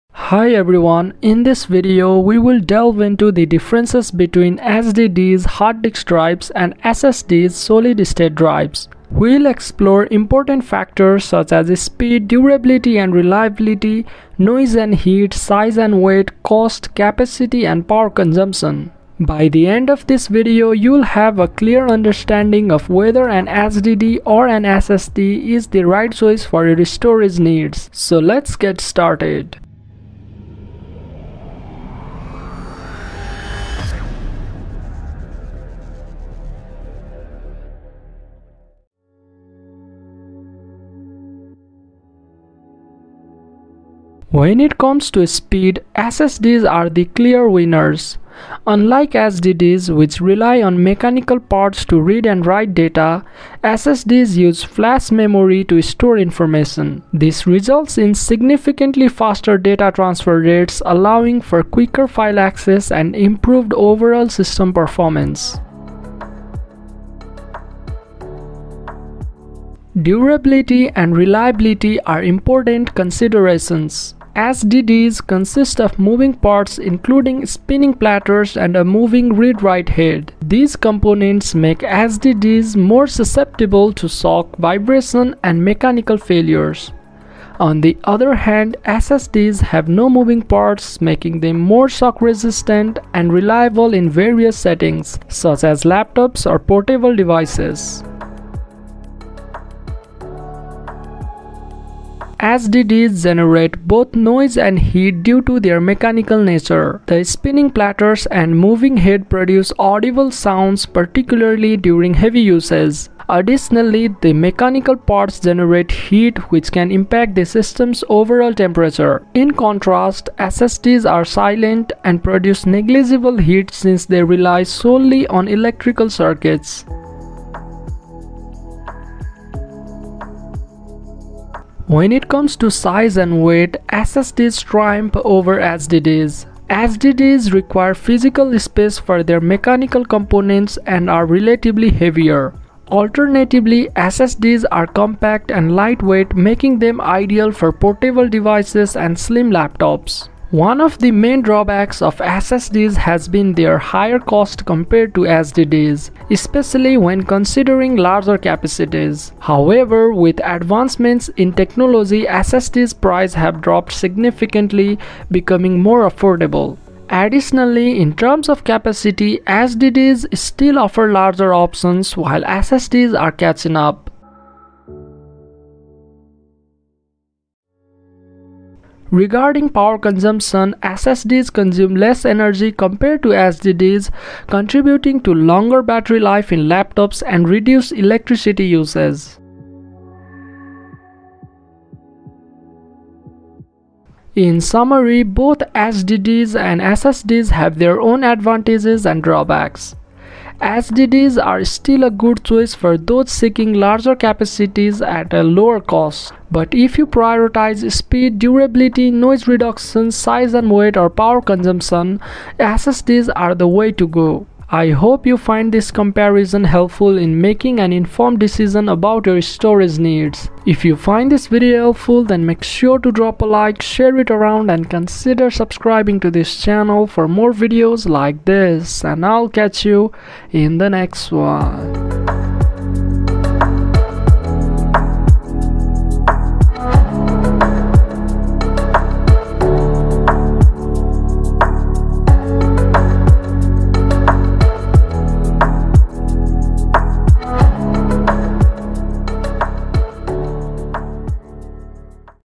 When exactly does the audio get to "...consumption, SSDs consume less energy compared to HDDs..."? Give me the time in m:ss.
2:59.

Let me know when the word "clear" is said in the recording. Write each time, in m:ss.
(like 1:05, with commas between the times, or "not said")
0:21, 0:47.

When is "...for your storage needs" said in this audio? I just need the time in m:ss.
0:26.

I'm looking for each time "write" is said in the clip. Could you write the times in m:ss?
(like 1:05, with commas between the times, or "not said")
0:52, 1:19.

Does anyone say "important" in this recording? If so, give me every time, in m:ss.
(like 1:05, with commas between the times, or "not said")
0:10, 1:12.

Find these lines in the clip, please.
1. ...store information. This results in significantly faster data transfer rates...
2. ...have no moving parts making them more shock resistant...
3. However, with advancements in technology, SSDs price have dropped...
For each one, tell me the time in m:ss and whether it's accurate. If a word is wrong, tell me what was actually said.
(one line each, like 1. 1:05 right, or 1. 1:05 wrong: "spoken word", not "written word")
1. 0:55 right
2. 1:29 right
3. 2:39 right.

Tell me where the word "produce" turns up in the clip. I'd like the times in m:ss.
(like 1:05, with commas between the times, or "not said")
1:49, 2:02.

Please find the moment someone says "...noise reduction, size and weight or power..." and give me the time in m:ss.
3:29.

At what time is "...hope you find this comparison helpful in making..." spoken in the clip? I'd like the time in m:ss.
3:34.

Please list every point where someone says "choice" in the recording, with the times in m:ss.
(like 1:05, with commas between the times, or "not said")
0:26, 3:22.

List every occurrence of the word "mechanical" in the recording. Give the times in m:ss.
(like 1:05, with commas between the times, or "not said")
0:50, 1:25, 1:45, 1:54, 2:19.